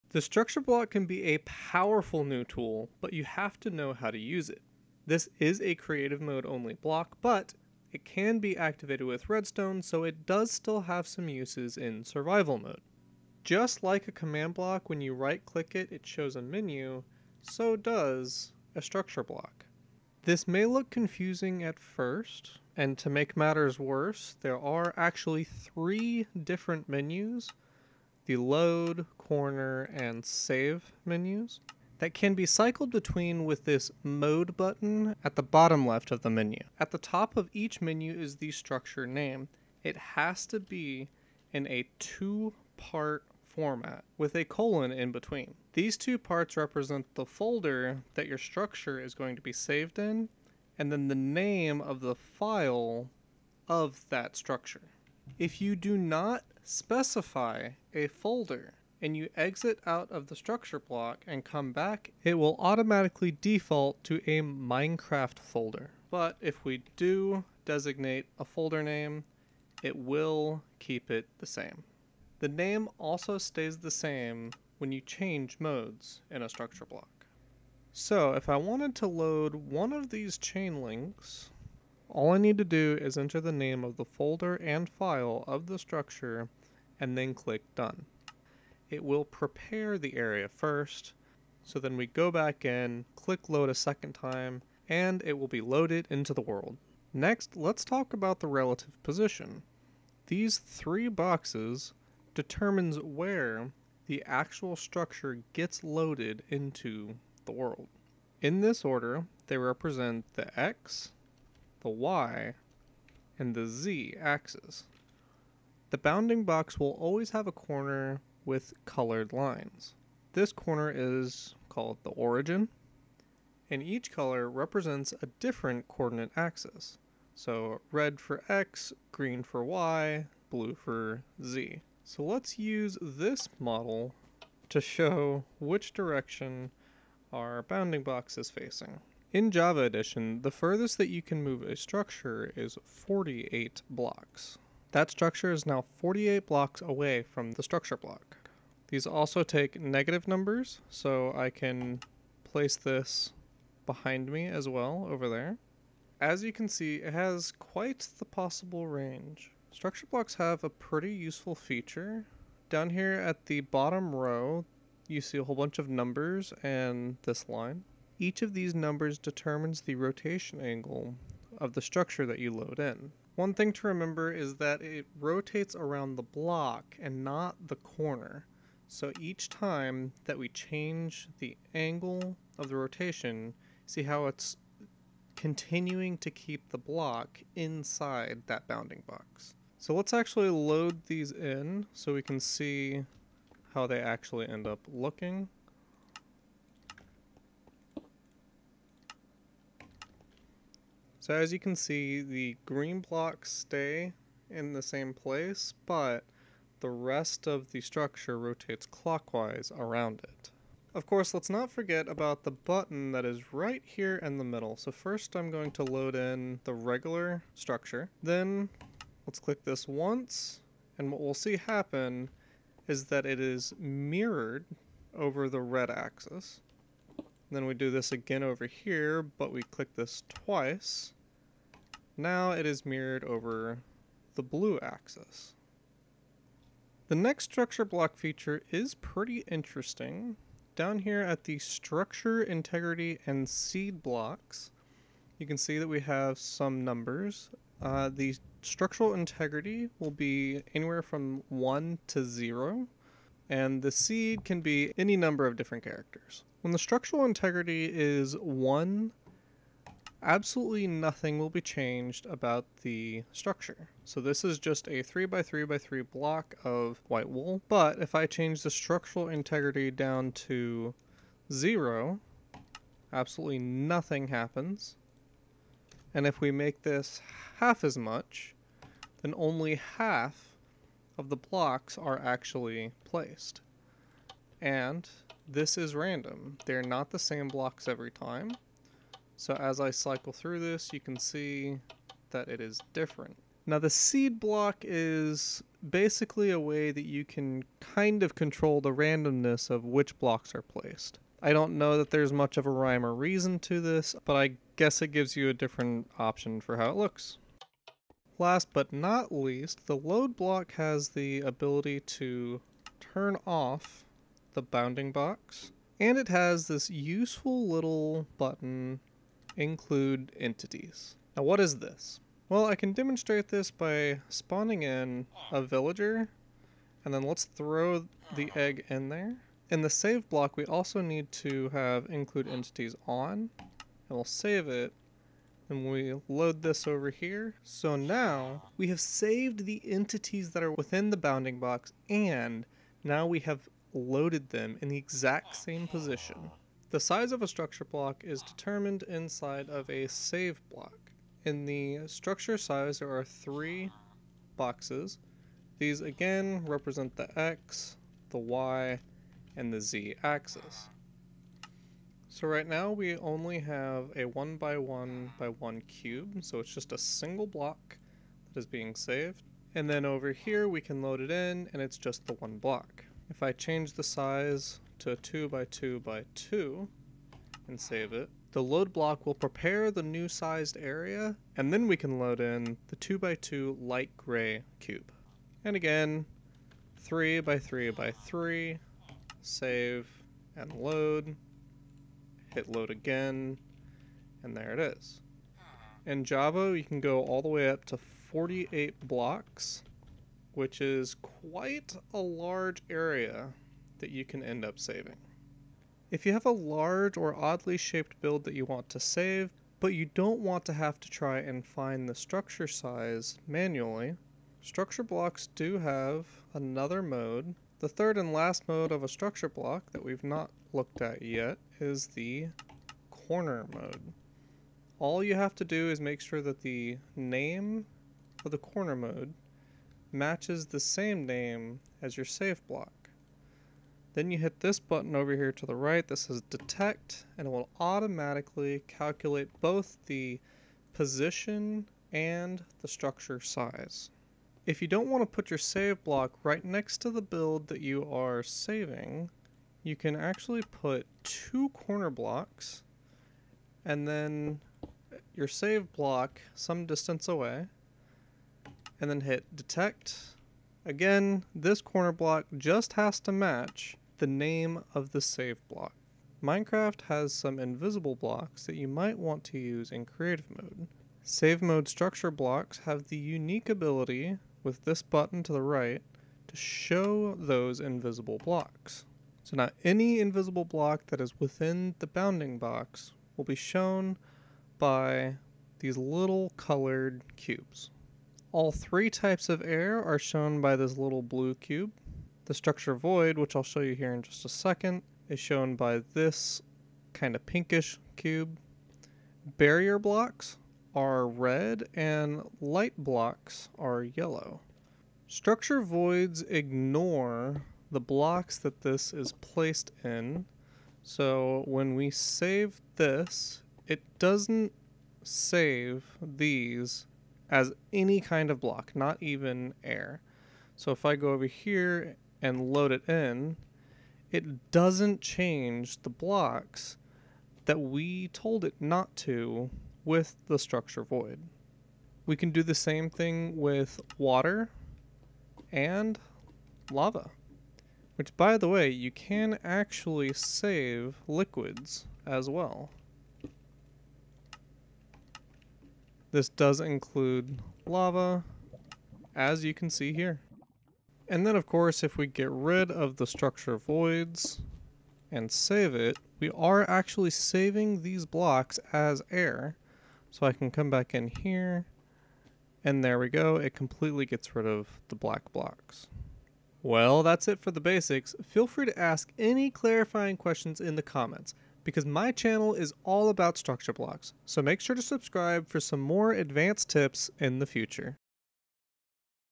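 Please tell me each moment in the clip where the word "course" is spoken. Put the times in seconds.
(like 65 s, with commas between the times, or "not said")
211 s, 551 s.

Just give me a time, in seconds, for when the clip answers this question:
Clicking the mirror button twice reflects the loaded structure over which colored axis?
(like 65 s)
234 s.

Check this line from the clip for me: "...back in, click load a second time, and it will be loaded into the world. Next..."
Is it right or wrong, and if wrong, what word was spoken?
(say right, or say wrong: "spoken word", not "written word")
right.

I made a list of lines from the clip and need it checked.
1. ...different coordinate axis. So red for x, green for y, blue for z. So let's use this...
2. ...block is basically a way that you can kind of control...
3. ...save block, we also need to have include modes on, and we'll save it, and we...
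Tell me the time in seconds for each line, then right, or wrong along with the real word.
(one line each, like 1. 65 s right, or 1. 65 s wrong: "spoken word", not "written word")
1. 125 s right
2. 294 s right
3. 329 s wrong: "entities", not "modes".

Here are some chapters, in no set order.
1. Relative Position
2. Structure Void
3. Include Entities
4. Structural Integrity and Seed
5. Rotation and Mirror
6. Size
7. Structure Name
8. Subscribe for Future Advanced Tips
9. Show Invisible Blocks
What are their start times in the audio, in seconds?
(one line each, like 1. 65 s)
1. 96 s
2. 504 s
3. 308 s
4. 236 s
5. 159 s
6. 346 s
7. 36 s
8. 566 s
9. 466 s.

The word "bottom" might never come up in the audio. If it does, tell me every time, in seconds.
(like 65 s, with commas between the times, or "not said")
35 s, 163 s.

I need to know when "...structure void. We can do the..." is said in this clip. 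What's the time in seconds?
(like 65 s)
530 s.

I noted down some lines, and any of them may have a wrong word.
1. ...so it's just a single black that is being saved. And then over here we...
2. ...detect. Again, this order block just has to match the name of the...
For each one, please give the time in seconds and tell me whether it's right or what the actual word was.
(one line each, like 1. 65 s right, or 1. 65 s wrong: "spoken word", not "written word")
1. 366 s wrong: "block", not "black"
2. 459 s wrong: "corner", not "order".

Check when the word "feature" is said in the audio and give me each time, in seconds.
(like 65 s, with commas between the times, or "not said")
161 s, 238 s.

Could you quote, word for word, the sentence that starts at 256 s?
When the structural integrity is 1, absolutely nothing will be changed about the structure.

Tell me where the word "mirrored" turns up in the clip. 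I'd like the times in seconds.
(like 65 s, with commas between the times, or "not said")
223 s, 232 s.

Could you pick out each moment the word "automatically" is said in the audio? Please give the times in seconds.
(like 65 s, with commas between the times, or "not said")
62 s, 437 s.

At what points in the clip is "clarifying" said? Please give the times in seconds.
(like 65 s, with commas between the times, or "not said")
569 s.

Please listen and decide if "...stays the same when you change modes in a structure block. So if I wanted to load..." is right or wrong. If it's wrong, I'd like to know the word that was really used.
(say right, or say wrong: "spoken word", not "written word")
right.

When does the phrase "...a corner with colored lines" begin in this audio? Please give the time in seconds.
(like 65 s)
117 s.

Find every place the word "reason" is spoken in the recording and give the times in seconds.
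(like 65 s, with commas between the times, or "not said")
303 s.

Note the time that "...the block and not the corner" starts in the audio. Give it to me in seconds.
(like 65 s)
176 s.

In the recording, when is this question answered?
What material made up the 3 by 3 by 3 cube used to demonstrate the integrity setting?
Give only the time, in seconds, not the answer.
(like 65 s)
267 s.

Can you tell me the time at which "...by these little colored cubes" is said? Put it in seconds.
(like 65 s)
484 s.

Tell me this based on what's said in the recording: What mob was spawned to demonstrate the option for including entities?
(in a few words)
A villager.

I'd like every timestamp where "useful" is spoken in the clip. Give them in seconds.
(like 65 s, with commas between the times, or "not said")
161 s, 316 s.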